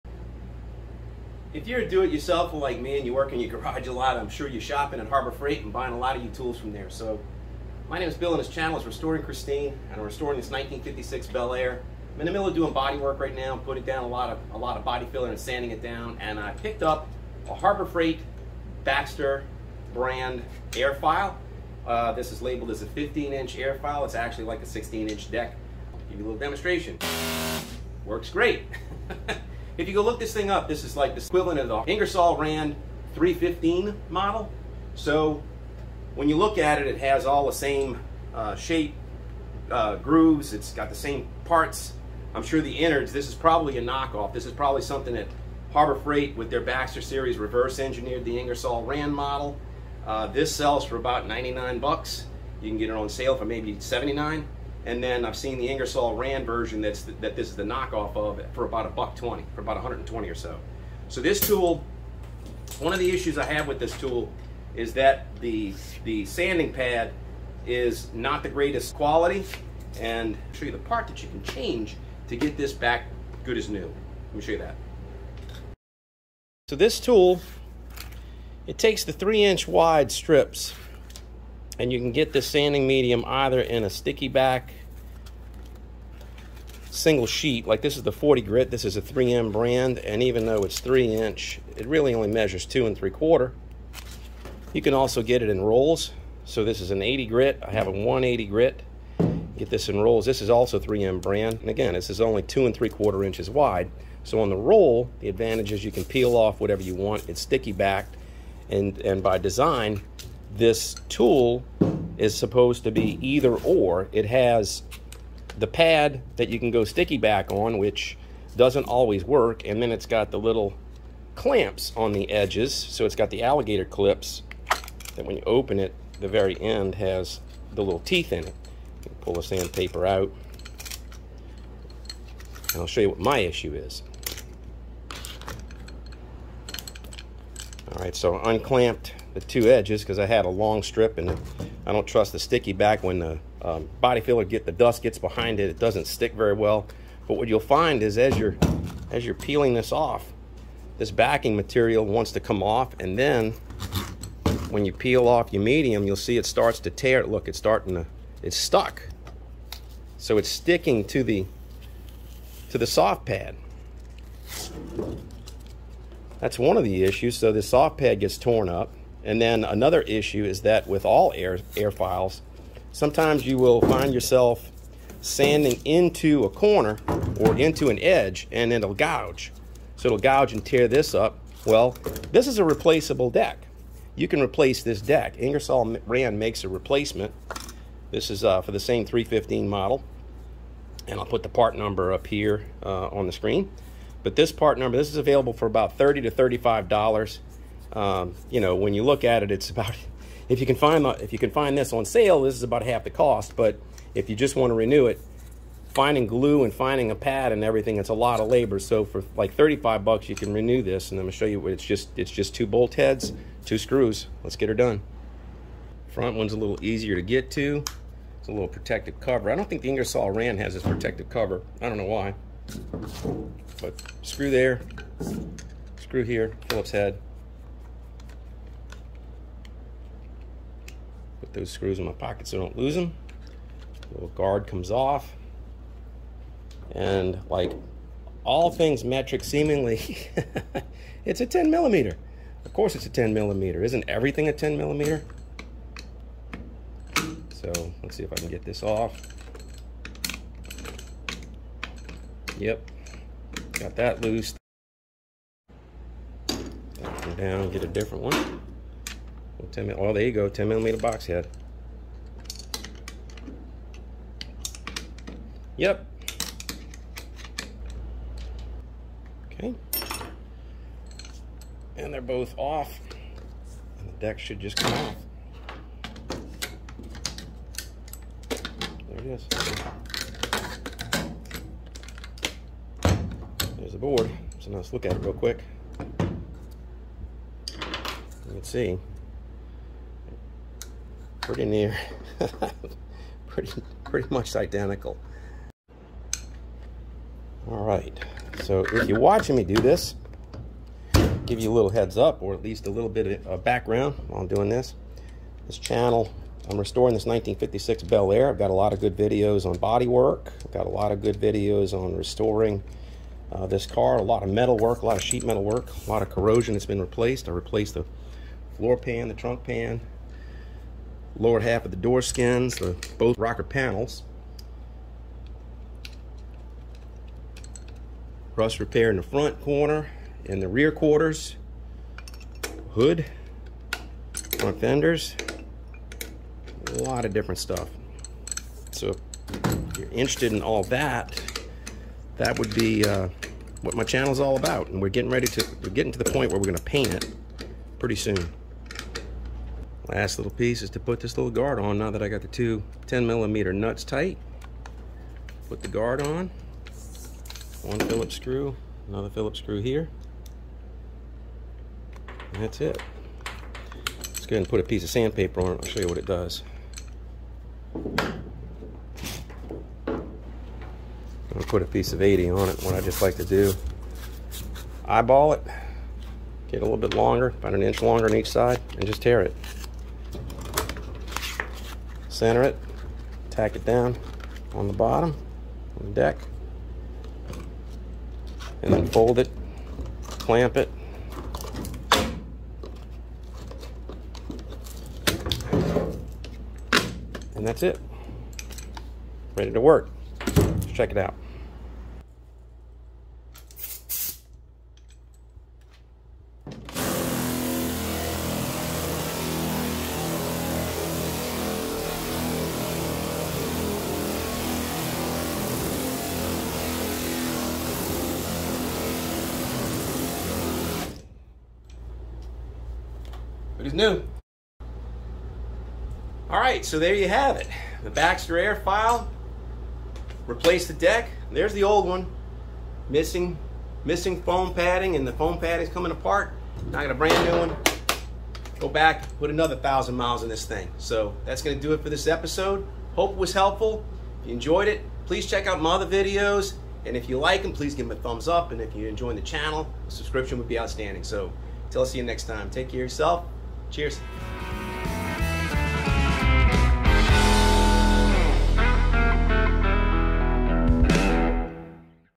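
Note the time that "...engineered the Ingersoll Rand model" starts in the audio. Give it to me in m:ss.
0:47.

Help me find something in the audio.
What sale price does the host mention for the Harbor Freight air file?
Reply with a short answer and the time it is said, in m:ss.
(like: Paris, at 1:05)
$79, at 0:53.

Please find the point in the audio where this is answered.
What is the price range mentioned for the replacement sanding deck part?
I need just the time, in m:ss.
3:15.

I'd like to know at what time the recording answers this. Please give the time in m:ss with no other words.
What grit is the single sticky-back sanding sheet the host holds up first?
1:28.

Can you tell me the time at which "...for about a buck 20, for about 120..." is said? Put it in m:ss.
0:58.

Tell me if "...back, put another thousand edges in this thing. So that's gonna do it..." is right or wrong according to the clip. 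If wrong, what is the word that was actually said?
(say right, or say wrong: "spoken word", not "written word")
wrong: "miles", not "edges".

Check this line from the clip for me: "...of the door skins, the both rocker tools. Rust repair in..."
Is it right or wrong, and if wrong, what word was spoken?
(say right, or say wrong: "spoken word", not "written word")
wrong: "panels", not "tools".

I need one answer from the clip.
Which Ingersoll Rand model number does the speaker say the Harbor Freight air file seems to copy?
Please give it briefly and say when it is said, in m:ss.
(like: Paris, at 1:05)
315, at 0:31.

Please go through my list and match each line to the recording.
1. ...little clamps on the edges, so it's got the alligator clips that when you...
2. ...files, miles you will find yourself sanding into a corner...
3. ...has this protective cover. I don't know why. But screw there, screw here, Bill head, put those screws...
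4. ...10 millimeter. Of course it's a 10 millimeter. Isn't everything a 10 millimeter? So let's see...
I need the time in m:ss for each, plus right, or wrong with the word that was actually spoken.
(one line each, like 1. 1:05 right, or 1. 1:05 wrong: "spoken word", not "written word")
1. 2:00 right
2. 2:51 wrong: "sometimes", not "miles"
3. 3:40 wrong: "Phillips", not "Bill"
4. 4:01 right.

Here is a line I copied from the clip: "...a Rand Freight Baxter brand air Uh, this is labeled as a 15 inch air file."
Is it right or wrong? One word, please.
wrong.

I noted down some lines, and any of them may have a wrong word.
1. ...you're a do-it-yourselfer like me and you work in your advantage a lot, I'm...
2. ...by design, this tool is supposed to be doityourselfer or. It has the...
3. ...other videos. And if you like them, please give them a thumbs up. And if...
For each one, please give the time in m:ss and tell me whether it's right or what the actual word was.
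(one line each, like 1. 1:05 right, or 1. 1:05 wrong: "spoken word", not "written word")
1. 0:01 wrong: "garage", not "advantage"
2. 1:49 wrong: "either", not "doityourselfer"
3. 7:25 right.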